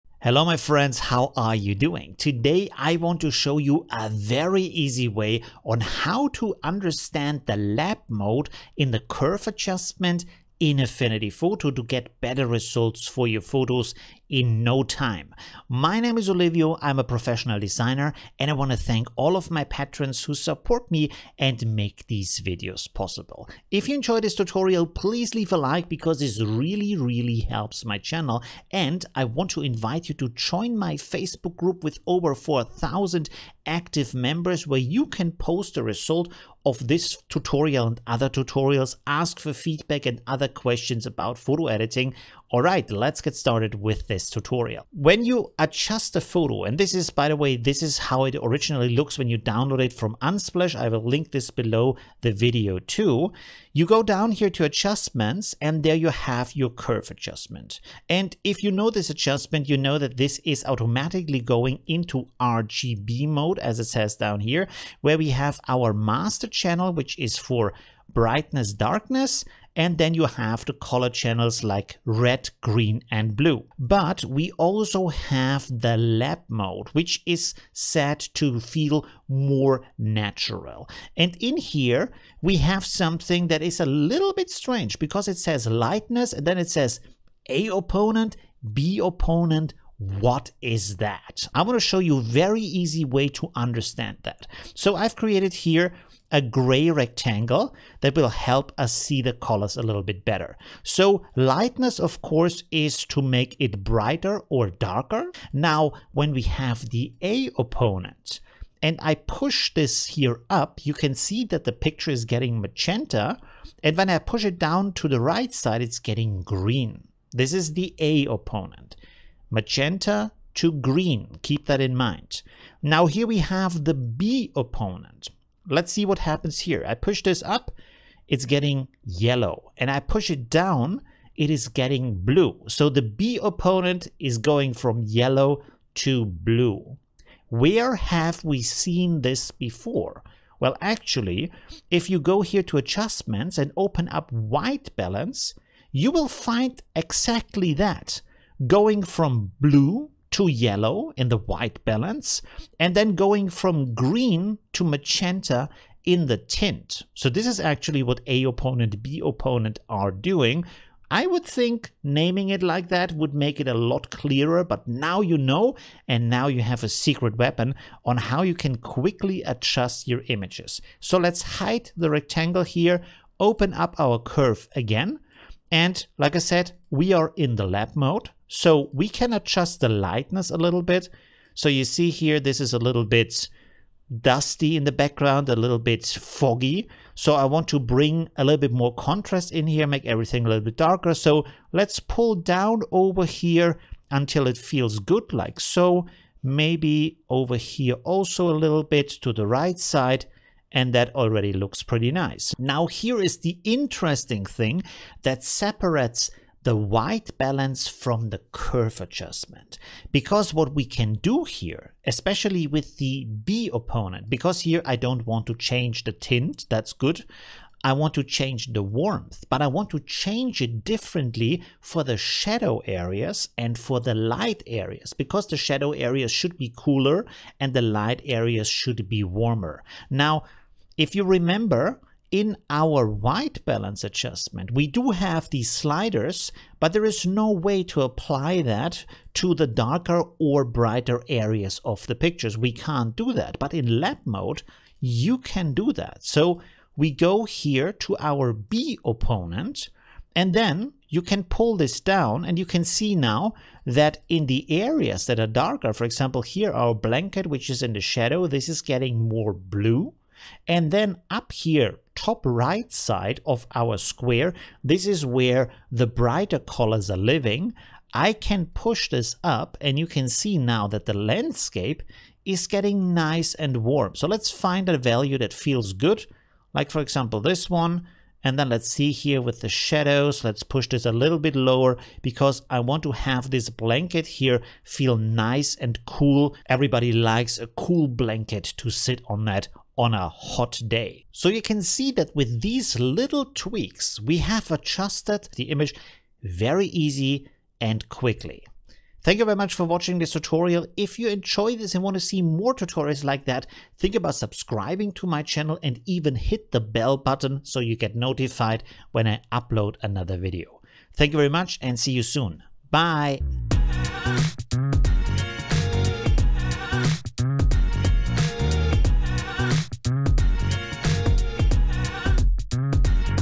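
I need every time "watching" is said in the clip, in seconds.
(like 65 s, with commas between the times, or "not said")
299 s.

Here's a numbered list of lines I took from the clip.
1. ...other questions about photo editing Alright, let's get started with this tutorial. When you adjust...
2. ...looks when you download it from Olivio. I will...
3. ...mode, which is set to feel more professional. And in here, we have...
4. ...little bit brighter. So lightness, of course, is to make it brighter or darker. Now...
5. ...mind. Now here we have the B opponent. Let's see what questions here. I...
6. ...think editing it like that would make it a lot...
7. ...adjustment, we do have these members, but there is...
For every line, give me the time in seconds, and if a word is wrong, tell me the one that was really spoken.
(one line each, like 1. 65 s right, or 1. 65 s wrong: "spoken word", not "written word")
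1. 40 s right
2. 48 s wrong: "Unsplash", not "Olivio"
3. 76 s wrong: "natural", not "professional"
4. 99 s wrong: "better", not "brighter"
5. 121 s wrong: "happens", not "questions"
6. 161 s wrong: "naming", not "editing"
7. 234 s wrong: "sliders", not "members".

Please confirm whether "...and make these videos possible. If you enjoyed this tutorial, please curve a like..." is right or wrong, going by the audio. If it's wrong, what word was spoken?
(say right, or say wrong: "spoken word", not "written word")
wrong: "leave", not "curve".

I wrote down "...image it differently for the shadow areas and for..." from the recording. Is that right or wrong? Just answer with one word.
wrong.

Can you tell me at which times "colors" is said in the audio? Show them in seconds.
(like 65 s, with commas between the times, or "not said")
70 s, 99 s, 266 s.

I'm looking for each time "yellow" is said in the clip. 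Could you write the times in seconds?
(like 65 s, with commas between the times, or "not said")
129 s, 135 s, 150 s.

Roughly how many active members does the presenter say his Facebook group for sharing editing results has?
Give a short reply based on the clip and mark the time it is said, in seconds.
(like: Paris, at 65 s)
over 4,000, at 32 s.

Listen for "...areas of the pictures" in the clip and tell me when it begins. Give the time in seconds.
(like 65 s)
241 s.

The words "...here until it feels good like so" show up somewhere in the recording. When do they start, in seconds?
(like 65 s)
193 s.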